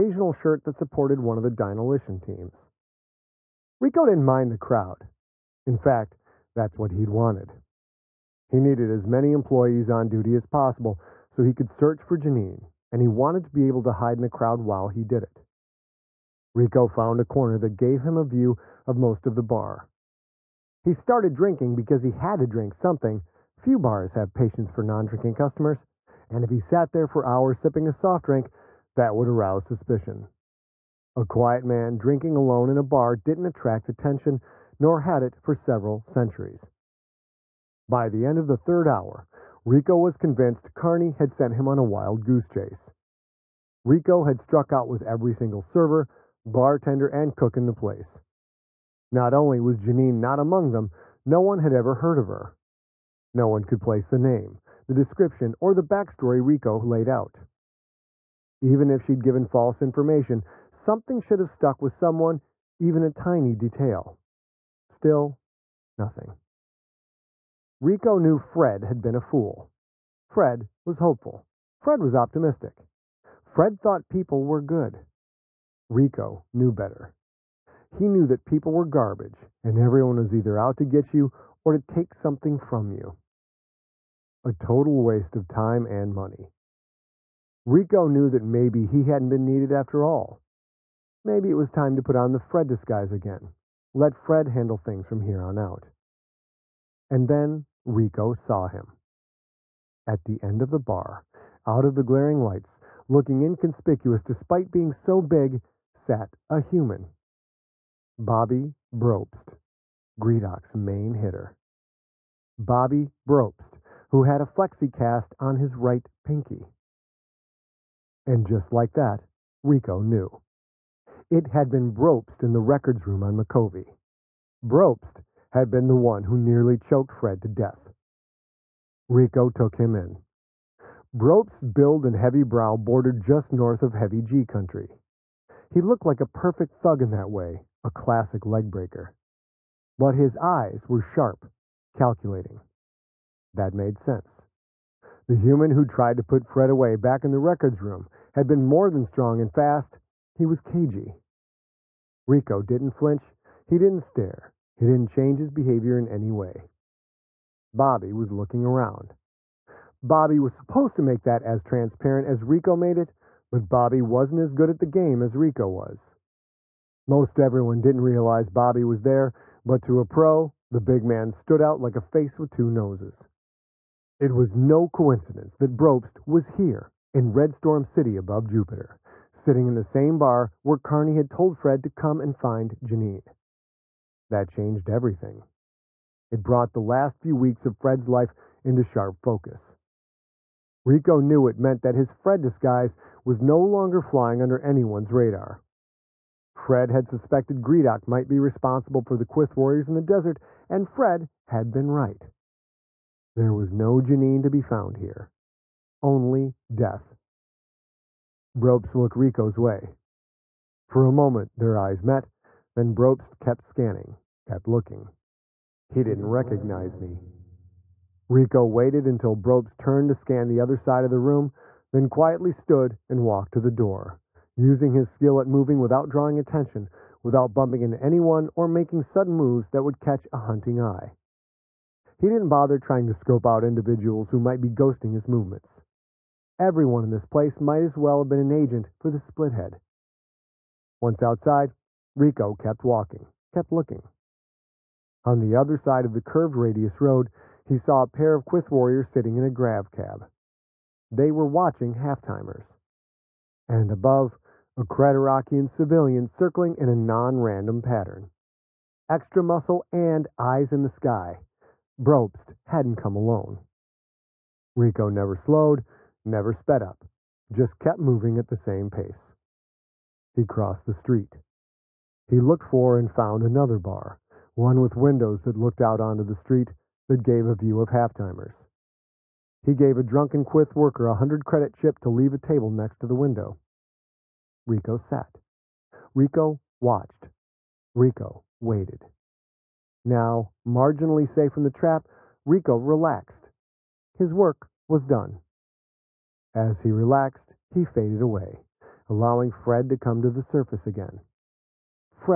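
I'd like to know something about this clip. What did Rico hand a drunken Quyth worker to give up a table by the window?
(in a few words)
100 credit chip.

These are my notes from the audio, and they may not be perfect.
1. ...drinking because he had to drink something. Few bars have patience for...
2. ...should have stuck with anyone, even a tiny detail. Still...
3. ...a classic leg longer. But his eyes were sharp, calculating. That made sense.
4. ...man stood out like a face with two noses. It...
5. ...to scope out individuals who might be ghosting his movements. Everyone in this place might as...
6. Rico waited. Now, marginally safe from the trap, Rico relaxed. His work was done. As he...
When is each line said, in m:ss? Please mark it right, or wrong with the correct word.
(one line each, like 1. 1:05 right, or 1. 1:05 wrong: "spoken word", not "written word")
1. 0:21 right
2. 1:01 wrong: "someone", not "anyone"
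3. 2:17 wrong: "breaker", not "longer"
4. 2:51 right
5. 3:53 right
6. 4:47 right.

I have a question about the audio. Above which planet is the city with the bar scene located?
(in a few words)
Jupiter.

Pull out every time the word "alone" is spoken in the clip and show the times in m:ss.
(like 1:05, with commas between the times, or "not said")
0:32, 4:23.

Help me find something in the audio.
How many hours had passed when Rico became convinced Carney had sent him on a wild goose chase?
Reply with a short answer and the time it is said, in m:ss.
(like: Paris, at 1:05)
3, at 0:38.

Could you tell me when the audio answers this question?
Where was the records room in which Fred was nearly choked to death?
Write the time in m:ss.
2:03.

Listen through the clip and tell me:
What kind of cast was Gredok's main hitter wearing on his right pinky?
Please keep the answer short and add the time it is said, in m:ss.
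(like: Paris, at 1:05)
flexicast, at 1:54.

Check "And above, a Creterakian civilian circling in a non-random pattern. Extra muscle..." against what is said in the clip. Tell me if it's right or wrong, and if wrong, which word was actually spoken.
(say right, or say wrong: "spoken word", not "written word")
right.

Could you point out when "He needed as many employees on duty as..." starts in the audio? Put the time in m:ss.
0:08.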